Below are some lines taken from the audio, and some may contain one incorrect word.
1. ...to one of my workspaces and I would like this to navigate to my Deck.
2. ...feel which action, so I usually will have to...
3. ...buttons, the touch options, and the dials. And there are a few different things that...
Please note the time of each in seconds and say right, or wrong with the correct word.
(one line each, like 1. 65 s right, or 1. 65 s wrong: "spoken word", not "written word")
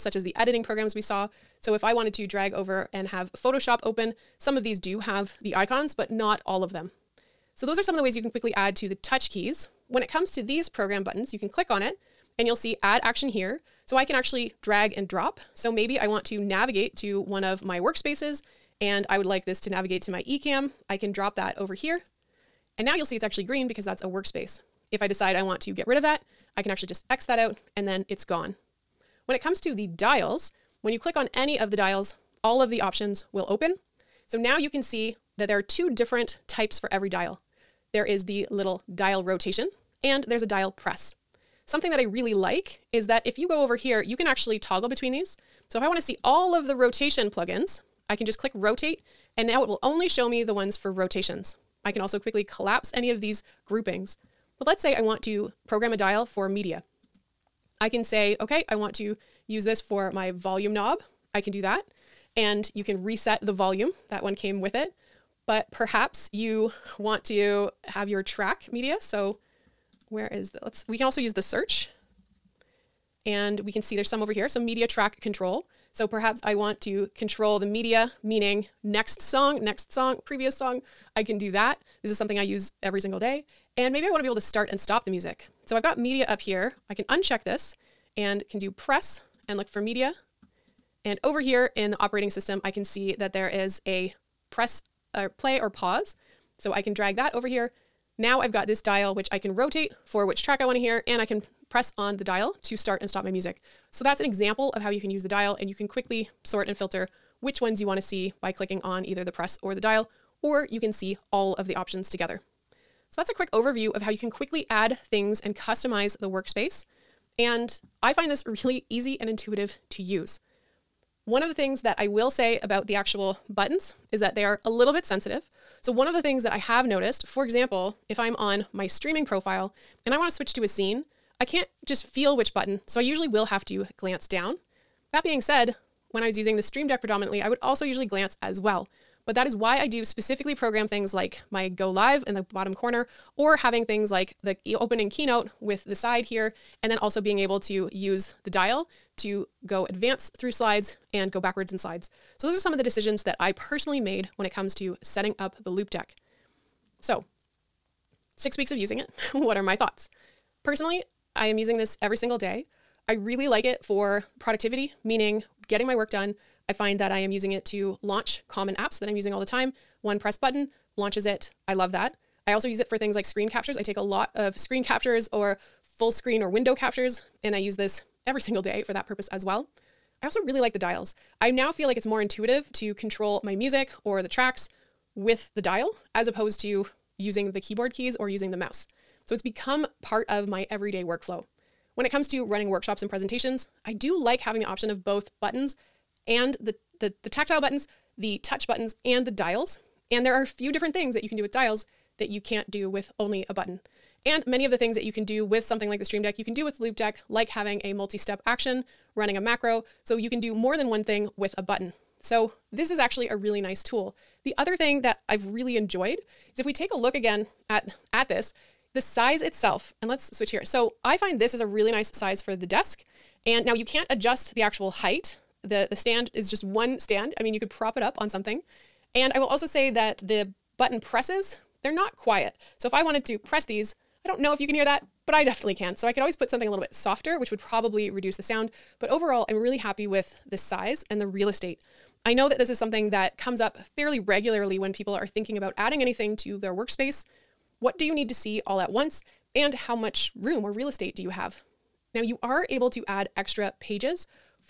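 1. 16 s wrong: "Ecamm", not "Deck"
2. 132 s wrong: "button", not "action"
3. 197 s wrong: "buttons", not "options".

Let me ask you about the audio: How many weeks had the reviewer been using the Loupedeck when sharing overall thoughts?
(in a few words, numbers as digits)
6.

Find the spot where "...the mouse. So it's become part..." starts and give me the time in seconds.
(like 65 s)
188 s.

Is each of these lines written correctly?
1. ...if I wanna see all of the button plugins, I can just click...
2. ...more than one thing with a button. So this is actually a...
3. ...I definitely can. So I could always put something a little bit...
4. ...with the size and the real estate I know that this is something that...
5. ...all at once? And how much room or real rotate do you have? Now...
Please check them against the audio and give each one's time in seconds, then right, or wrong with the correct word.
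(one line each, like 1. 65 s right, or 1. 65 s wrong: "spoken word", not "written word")
1. 45 s wrong: "rotation", not "button"
2. 210 s right
3. 235 s right
4. 240 s right
5. 248 s wrong: "estate", not "rotate".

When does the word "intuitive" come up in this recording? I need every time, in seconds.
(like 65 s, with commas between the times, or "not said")
119 s, 182 s.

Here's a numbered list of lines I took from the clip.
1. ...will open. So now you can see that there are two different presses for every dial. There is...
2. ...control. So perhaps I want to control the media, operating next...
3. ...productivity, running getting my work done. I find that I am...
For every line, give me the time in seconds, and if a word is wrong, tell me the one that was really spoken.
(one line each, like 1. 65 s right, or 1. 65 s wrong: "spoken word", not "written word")
1. 33 s wrong: "types", not "presses"
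2. 75 s wrong: "meaning", not "operating"
3. 164 s wrong: "meaning", not "running".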